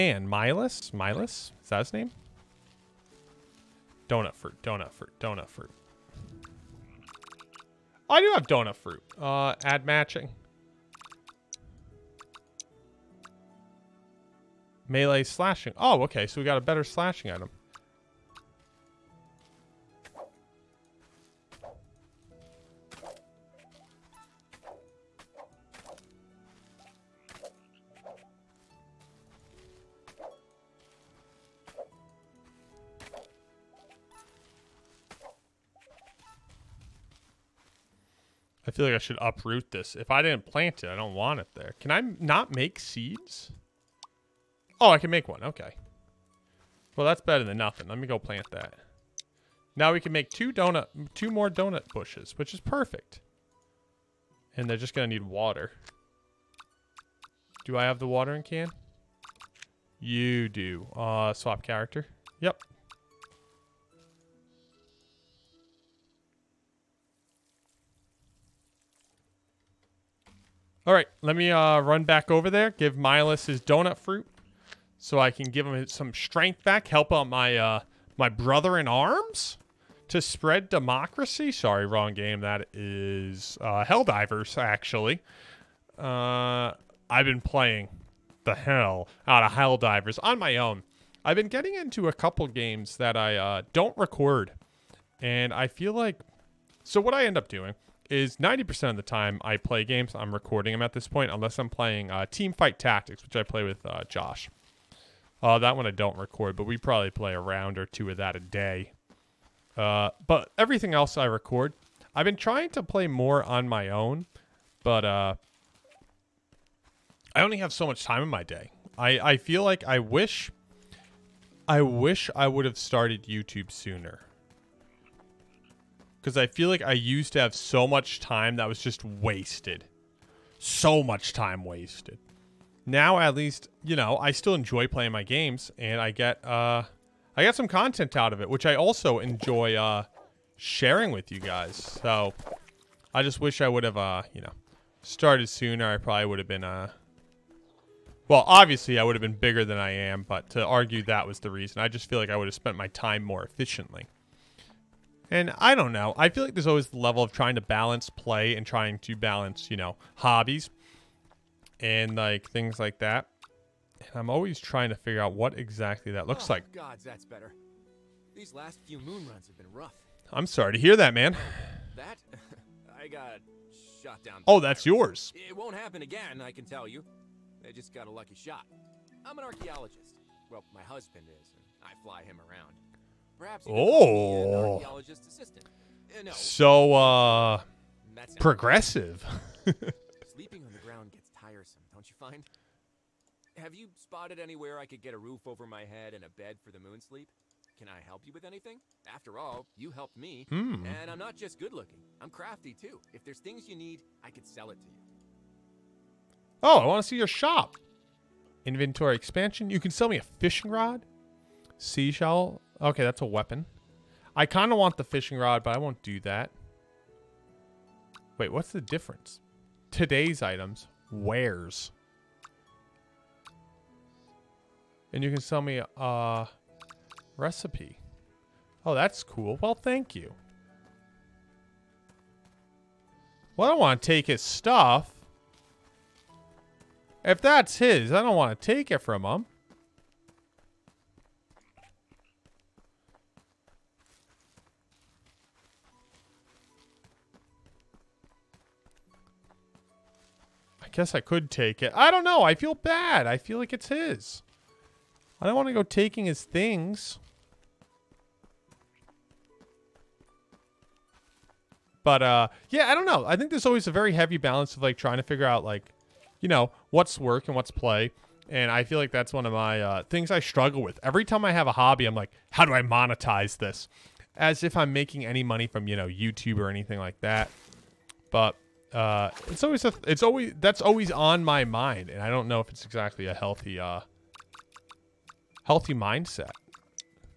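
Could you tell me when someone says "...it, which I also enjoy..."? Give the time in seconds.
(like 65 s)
138 s.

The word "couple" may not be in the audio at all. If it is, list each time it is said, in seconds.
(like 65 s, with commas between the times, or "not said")
92 s.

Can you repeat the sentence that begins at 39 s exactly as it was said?
If I didn't plant it, I don't want it there.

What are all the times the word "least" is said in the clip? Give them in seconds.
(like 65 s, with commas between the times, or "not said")
133 s.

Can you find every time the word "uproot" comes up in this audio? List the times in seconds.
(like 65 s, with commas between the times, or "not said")
39 s.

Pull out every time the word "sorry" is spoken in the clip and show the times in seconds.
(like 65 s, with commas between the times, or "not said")
81 s, 170 s.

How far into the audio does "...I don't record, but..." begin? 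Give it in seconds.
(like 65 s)
105 s.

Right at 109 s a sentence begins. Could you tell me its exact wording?
Uh, but everything else I record.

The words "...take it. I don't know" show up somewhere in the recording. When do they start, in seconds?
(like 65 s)
251 s.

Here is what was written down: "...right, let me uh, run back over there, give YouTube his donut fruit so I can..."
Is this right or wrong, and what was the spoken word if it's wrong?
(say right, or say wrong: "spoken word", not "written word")
wrong: "Milas", not "YouTube".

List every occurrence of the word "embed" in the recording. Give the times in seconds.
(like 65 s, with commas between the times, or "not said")
not said.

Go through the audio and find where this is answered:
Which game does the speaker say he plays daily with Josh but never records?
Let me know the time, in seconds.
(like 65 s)
102 s.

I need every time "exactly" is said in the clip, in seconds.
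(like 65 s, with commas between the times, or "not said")
165 s, 282 s.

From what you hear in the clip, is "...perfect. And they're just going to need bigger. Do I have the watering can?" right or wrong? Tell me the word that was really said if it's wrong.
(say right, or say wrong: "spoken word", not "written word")
wrong: "water", not "bigger".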